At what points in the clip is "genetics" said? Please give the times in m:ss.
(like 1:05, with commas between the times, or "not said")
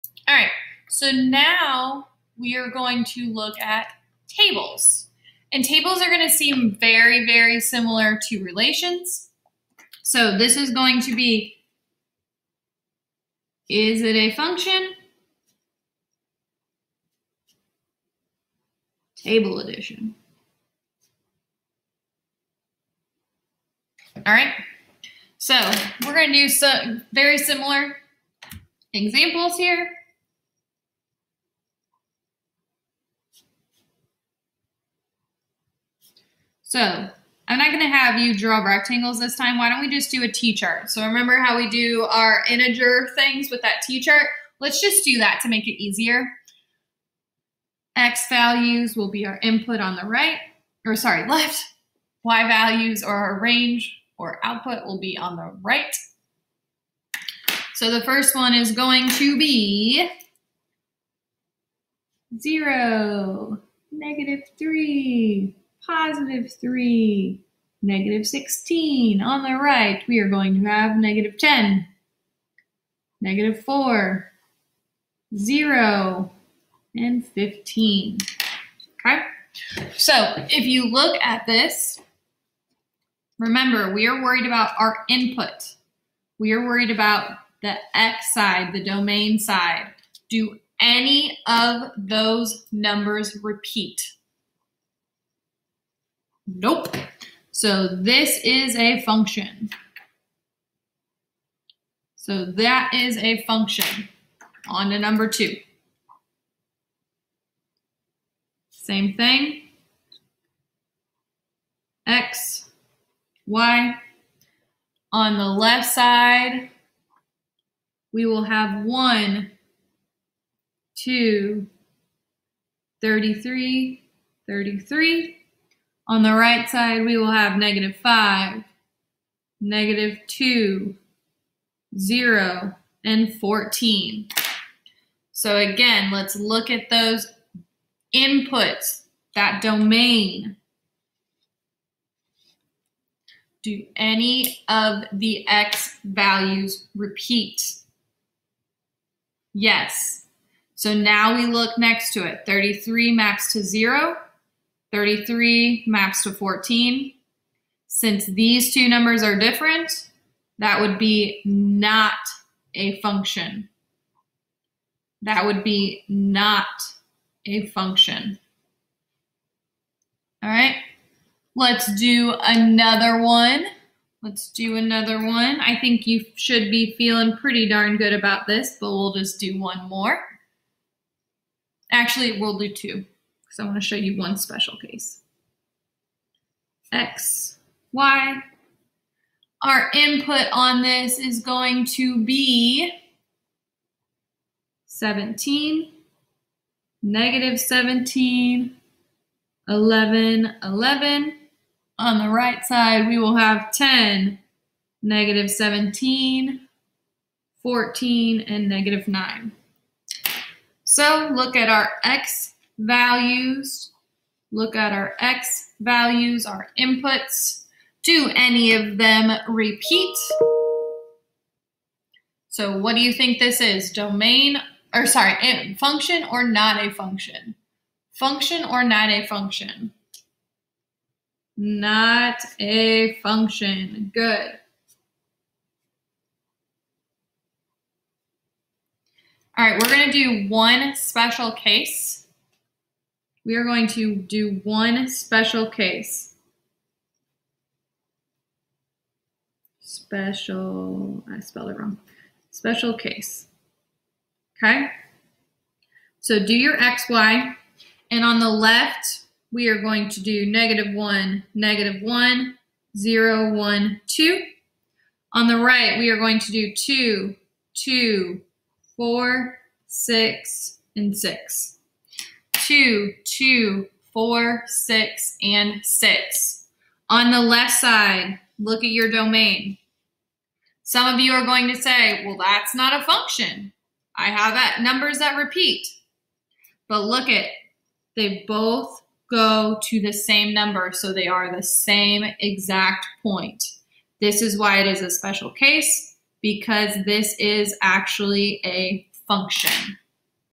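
not said.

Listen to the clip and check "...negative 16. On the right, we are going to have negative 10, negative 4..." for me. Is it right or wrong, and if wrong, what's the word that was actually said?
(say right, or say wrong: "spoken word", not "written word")
right.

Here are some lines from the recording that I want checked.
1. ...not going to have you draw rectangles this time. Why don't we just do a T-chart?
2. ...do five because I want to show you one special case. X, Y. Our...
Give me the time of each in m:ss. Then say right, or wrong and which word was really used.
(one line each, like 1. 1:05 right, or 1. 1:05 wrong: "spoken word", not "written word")
1. 0:37 right
2. 3:02 wrong: "two", not "five".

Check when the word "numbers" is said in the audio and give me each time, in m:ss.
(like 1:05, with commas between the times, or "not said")
1:32, 1:44, 2:38, 4:44, 4:50.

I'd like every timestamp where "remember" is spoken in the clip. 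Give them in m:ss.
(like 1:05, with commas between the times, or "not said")
0:41, 1:23.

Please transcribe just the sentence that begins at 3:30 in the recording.
So look at our x values, look at our X values, our inputs.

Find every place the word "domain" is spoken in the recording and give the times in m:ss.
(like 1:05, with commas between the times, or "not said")
1:28, 2:19, 3:43, 4:39.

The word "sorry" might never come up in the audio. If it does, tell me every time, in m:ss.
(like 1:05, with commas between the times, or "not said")
0:50, 3:45.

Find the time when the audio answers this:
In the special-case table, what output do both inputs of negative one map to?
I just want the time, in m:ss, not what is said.
4:26.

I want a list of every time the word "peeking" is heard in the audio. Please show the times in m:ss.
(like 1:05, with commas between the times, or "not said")
not said.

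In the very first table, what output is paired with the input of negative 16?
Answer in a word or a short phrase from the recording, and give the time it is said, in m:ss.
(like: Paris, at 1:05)
15, at 1:17.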